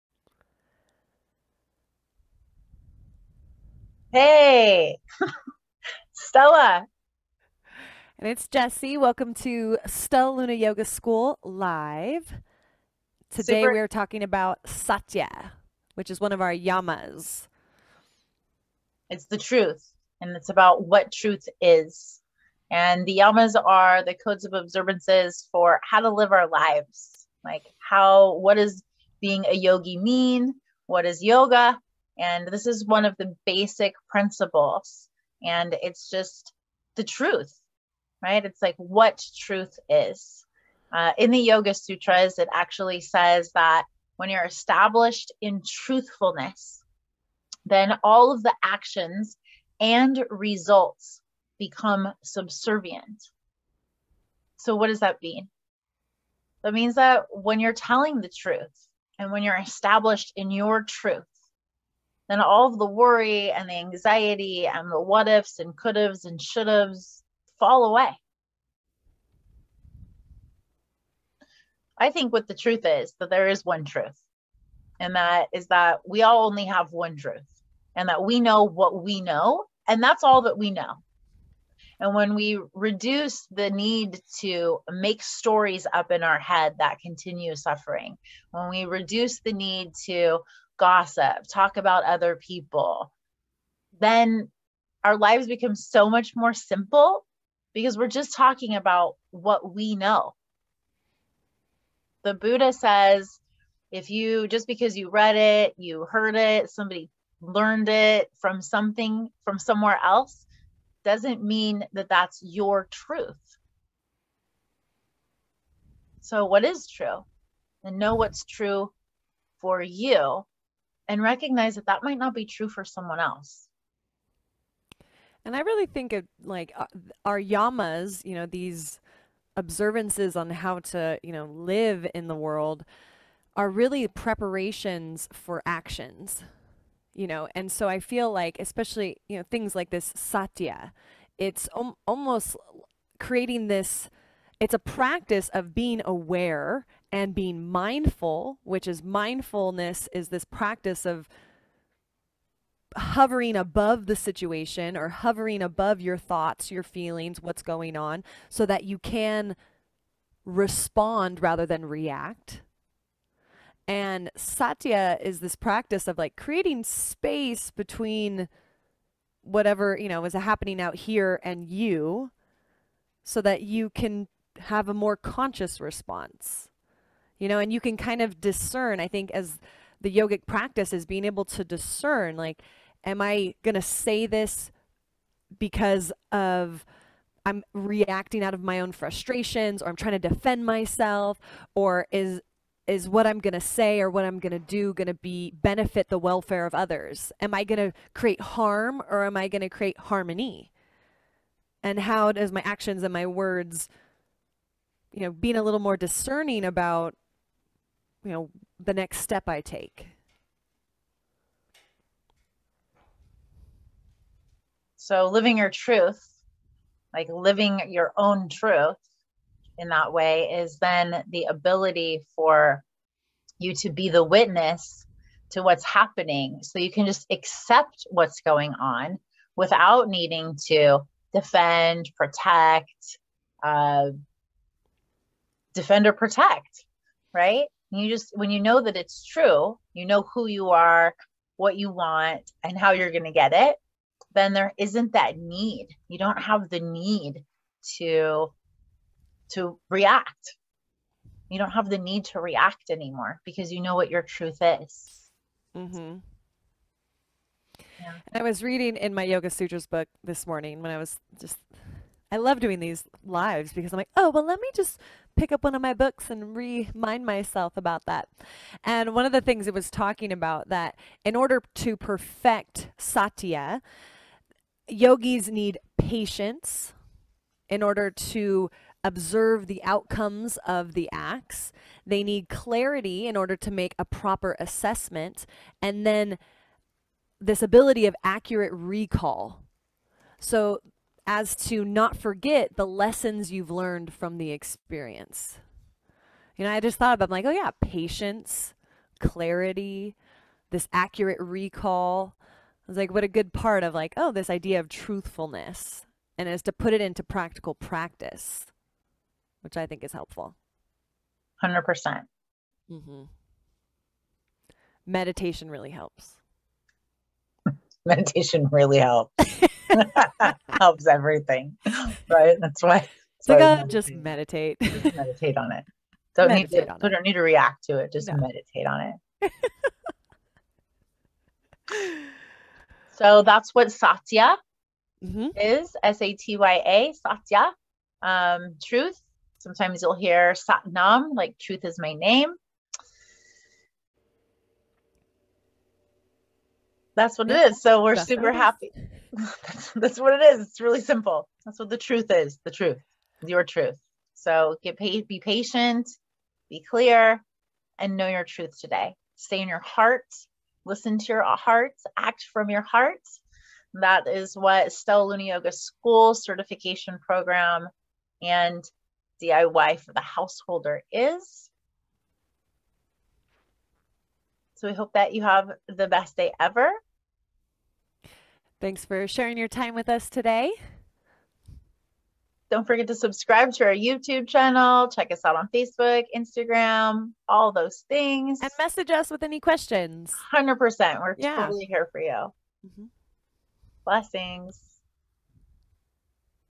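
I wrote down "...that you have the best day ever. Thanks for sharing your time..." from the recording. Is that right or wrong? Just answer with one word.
right.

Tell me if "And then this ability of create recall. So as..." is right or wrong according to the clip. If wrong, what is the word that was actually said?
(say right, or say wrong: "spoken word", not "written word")
wrong: "accurate", not "create".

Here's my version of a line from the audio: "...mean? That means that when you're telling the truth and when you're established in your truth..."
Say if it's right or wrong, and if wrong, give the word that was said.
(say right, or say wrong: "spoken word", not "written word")
right.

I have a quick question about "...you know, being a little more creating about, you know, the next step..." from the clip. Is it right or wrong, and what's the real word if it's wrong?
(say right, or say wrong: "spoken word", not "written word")
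wrong: "discerning", not "creating".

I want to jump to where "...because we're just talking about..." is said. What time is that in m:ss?
1:37.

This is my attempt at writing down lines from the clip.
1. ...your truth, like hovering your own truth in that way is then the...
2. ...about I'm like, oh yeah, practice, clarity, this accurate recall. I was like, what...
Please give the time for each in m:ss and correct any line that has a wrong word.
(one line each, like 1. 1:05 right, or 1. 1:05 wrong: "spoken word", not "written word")
1. 3:35 wrong: "living", not "hovering"
2. 4:57 wrong: "patience", not "practice".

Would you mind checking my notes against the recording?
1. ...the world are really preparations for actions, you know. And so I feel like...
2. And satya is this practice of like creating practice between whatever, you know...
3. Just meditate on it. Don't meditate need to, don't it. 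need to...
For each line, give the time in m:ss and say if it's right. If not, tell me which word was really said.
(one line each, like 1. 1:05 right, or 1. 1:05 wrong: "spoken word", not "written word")
1. 2:12 right
2. 2:43 wrong: "space", not "practice"
3. 5:24 right.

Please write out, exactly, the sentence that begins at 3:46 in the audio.
So you can just accept what's going on without needing to defend, protect, uh, defend or protect, right?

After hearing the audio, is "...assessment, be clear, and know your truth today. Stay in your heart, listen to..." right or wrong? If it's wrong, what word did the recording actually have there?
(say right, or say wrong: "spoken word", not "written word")
wrong: "patient", not "assessment".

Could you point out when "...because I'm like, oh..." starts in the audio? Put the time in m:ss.
4:23.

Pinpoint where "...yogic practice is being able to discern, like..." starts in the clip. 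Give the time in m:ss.
3:00.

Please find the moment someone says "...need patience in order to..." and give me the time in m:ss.
4:35.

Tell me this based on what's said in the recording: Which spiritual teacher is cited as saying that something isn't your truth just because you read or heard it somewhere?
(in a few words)
The Buddha.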